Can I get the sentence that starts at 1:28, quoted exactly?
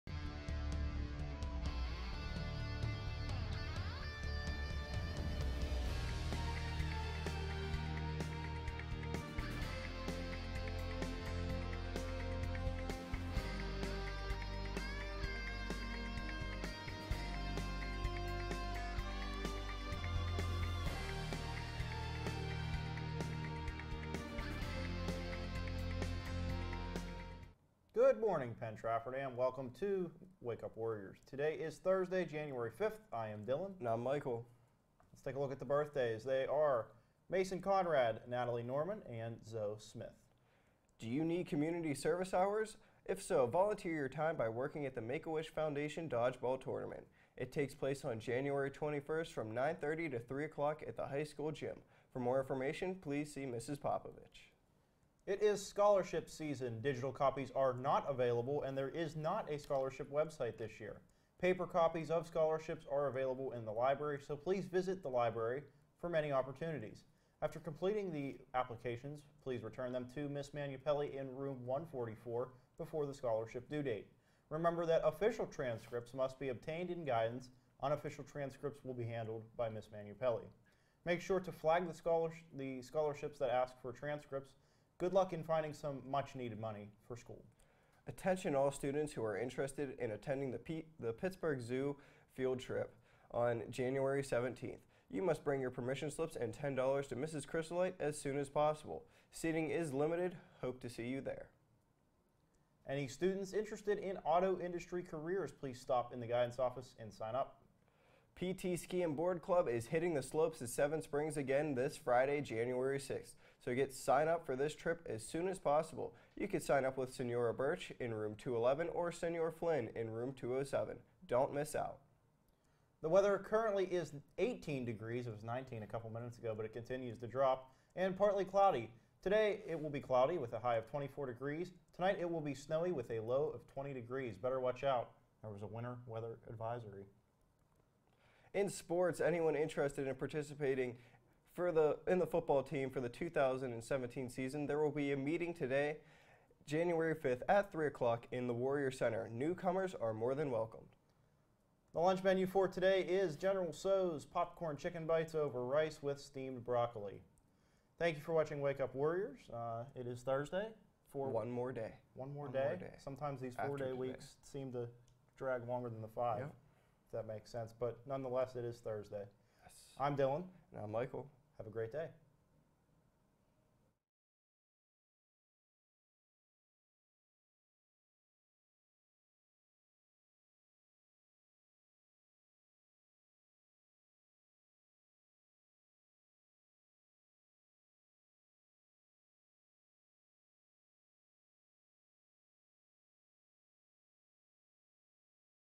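Attention all students who are interested in attending the, P the Pittsburgh Zoo field trip on January 17th.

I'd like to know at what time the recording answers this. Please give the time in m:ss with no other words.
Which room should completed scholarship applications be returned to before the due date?
1:11.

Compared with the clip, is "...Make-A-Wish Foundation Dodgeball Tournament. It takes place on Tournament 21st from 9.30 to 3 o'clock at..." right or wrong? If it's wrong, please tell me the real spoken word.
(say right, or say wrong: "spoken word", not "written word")
wrong: "January", not "Tournament".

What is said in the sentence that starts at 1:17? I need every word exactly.
Unofficial transcripts will be handled by Ms.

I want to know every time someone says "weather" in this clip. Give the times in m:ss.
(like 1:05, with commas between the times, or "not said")
2:03, 2:16.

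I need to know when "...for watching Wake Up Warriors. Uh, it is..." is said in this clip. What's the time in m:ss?
2:38.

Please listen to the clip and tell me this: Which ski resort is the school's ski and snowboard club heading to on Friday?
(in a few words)
Seven Springs.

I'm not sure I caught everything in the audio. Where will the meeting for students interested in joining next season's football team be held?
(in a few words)
Warrior Center.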